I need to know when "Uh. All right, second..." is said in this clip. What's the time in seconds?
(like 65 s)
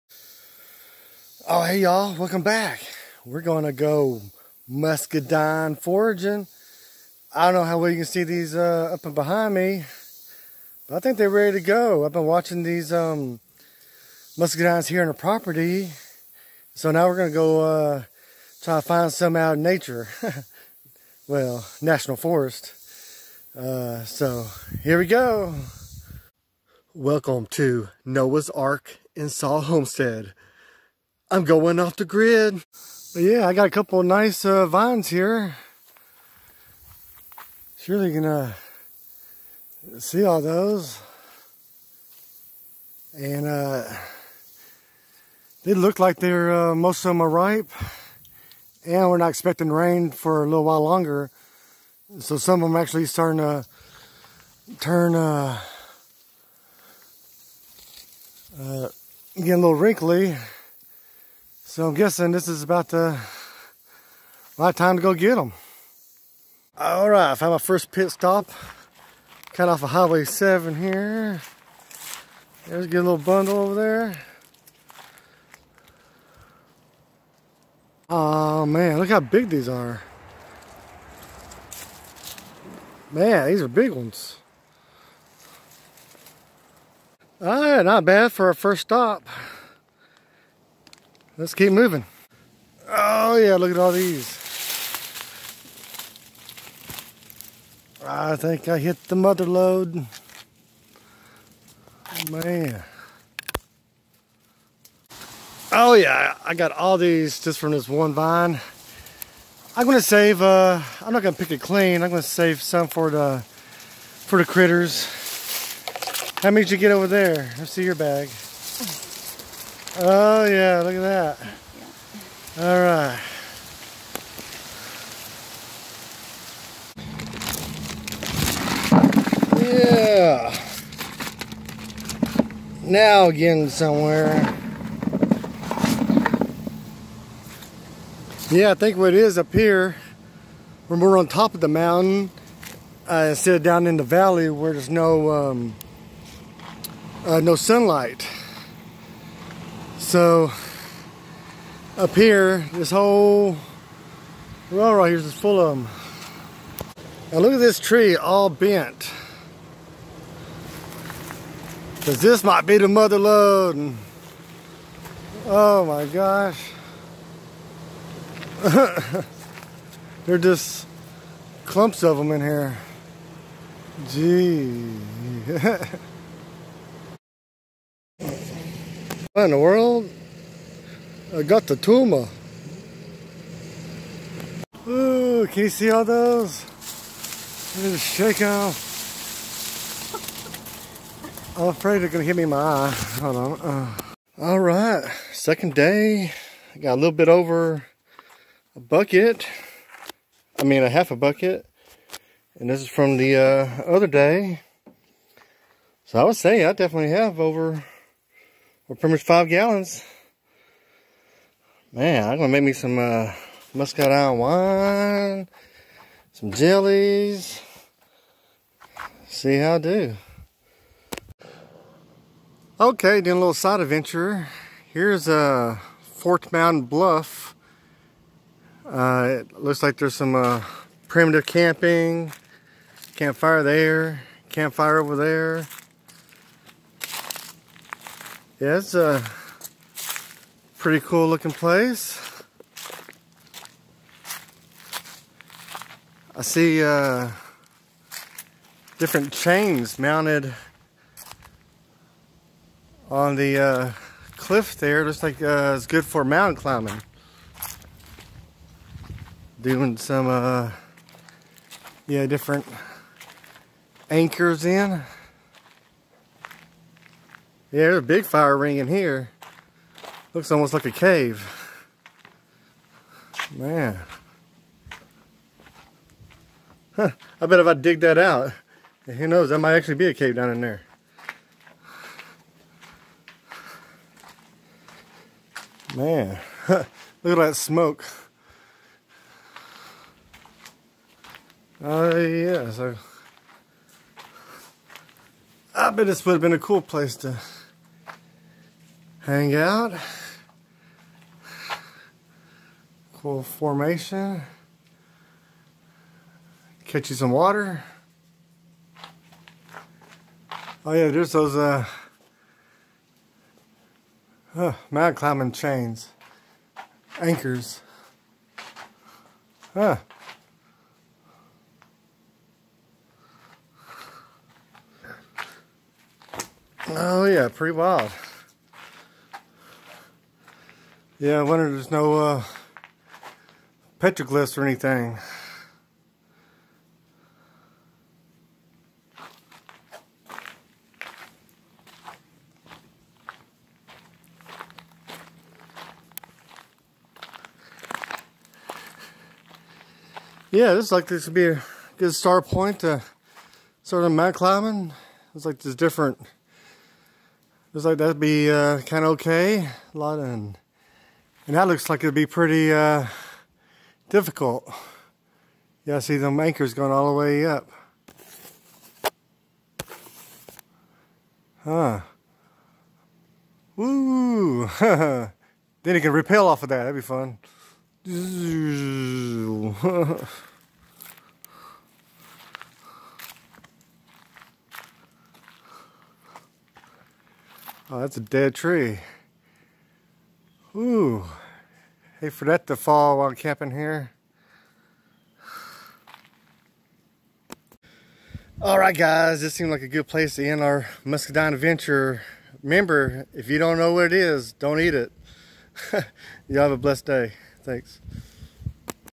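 193 s.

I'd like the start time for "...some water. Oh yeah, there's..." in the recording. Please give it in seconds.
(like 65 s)
307 s.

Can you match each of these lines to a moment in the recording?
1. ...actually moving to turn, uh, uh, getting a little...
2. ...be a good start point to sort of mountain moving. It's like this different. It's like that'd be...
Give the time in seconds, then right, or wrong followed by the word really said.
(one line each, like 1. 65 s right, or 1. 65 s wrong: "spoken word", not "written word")
1. 52 s wrong: "starting", not "moving"
2. 351 s wrong: "climbing", not "moving".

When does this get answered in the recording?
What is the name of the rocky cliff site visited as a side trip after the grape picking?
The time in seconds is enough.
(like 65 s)
226 s.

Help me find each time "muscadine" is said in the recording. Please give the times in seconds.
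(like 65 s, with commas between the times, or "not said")
4 s, 14 s, 213 s, 401 s.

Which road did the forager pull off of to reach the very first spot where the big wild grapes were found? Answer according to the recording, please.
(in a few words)
Highway 7.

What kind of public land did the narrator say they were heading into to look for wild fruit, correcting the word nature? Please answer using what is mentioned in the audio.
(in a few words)
National Forest.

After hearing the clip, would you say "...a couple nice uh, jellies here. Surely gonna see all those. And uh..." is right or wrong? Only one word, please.
wrong.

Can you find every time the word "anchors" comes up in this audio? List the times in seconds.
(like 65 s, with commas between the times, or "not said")
264 s, 317 s, 366 s.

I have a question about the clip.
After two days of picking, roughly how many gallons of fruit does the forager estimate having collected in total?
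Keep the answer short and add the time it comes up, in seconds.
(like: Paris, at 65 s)
5 gallons, at 209 s.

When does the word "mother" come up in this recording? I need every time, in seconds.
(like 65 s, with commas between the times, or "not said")
99 s, 162 s.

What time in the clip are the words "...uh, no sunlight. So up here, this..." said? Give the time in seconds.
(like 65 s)
147 s.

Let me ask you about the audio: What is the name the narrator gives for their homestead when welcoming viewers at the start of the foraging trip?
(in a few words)
Noah's Ark in Saw Homestead.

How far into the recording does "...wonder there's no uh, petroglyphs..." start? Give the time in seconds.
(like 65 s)
331 s.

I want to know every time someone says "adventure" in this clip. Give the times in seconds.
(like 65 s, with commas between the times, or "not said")
223 s, 401 s.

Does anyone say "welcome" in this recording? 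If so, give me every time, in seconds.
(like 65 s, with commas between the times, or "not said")
2 s, 26 s.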